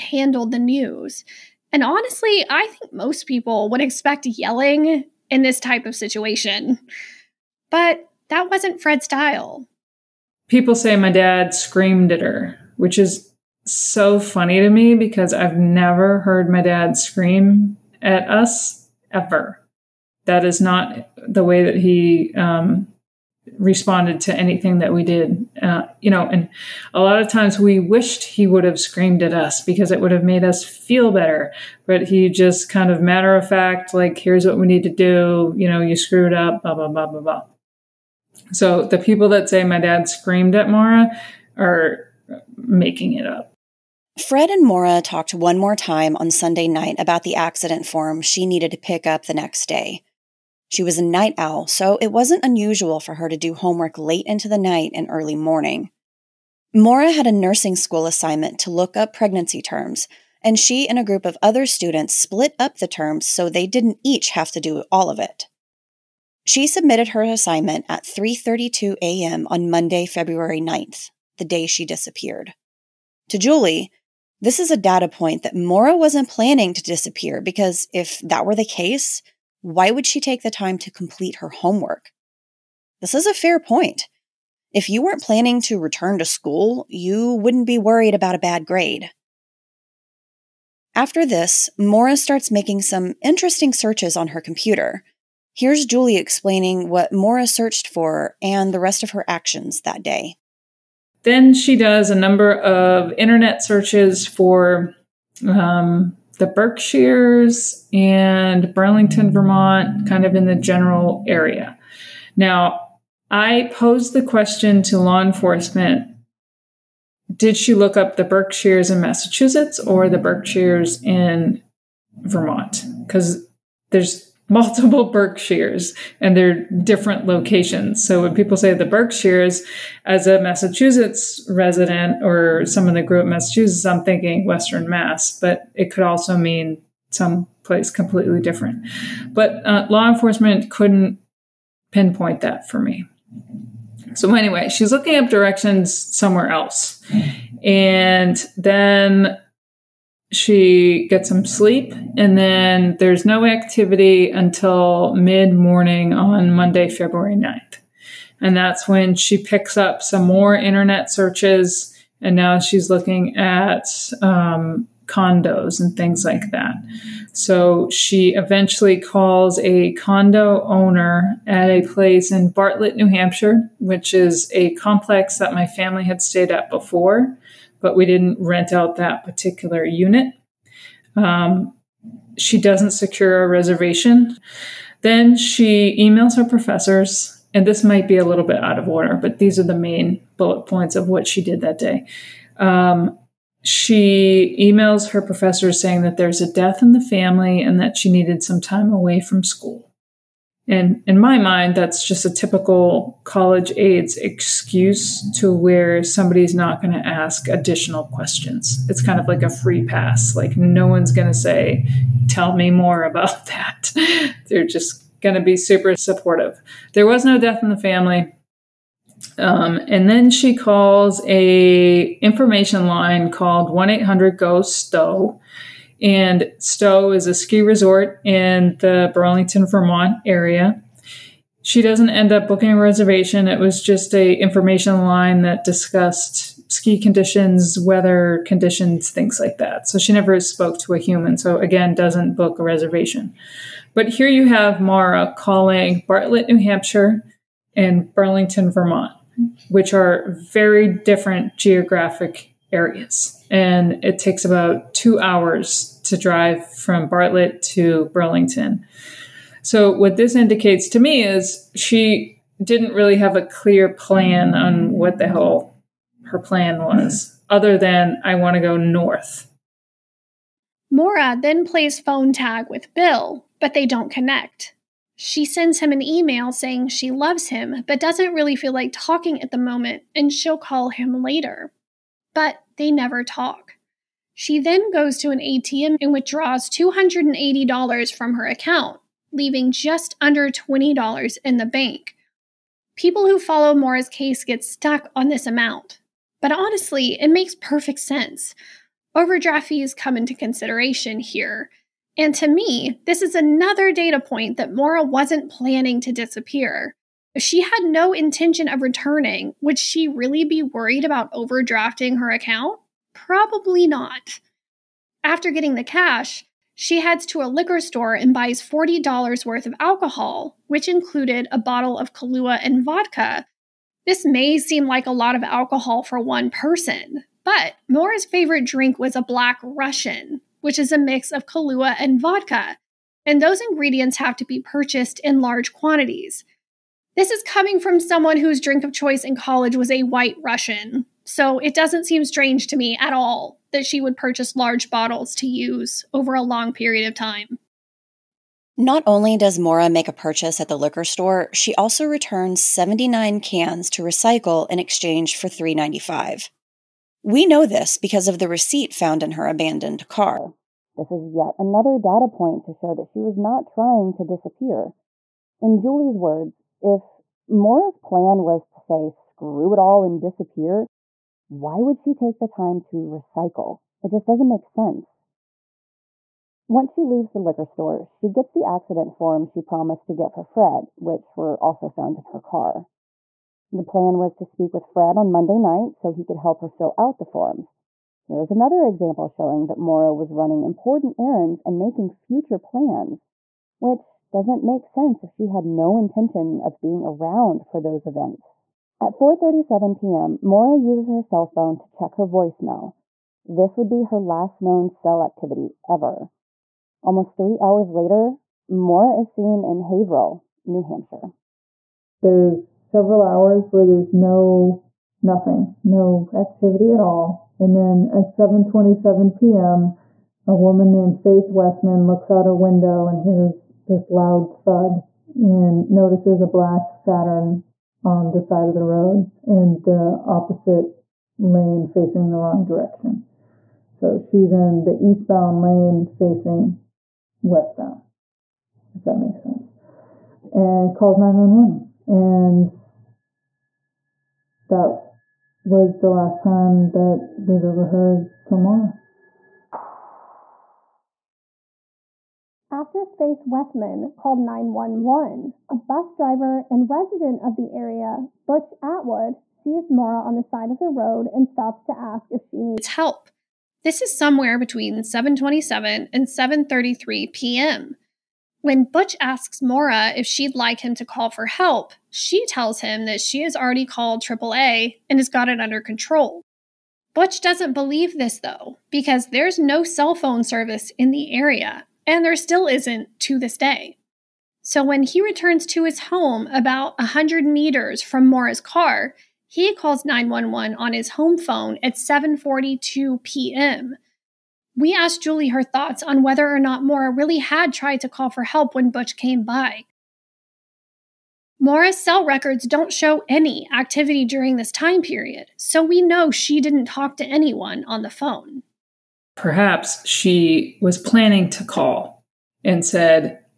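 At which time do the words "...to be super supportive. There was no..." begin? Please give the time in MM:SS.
03:35.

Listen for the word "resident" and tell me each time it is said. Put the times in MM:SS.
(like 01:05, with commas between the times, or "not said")
02:11, 07:36.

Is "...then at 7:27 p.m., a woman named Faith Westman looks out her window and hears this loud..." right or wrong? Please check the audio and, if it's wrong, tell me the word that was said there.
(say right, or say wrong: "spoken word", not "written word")
right.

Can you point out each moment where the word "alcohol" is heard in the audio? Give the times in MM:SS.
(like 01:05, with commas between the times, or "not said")
05:19, 05:25.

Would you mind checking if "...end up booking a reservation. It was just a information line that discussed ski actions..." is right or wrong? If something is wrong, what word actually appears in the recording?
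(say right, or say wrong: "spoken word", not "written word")
wrong: "conditions", not "actions".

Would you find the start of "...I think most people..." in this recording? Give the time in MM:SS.
00:02.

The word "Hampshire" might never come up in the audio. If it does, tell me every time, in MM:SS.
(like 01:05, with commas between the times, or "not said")
02:53, 04:06, 06:50.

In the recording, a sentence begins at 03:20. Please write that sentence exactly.
And in my mind, that's just a typical college aides excuse to where somebody's not going to ask additional questions.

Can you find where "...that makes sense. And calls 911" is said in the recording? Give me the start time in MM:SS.
07:19.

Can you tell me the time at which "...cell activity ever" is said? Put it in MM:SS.
06:44.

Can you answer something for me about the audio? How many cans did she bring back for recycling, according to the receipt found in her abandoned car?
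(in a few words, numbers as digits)
79.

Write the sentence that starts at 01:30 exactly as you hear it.
After this, Maura starts making some interesting searches on her computer.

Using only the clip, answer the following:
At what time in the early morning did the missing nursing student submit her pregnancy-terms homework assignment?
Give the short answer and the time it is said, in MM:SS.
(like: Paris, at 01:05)
3:32 a.m., at 01:08.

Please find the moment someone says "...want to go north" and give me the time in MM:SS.
04:28.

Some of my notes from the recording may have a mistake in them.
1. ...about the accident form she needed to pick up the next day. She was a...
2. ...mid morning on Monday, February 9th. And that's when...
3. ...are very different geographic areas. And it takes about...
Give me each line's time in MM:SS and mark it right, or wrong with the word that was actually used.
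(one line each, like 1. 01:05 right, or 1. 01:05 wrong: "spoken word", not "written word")
1. 00:46 right
2. 02:35 right
3. 04:09 right.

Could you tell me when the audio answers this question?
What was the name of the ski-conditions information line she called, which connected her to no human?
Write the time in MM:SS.
03:43.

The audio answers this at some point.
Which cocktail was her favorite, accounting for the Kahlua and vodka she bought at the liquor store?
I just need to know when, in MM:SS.
05:29.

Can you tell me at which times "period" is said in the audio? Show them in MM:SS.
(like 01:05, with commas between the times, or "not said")
05:46, 08:25.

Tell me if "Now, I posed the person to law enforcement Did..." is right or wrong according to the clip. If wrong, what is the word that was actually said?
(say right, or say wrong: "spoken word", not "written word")
wrong: "question", not "person".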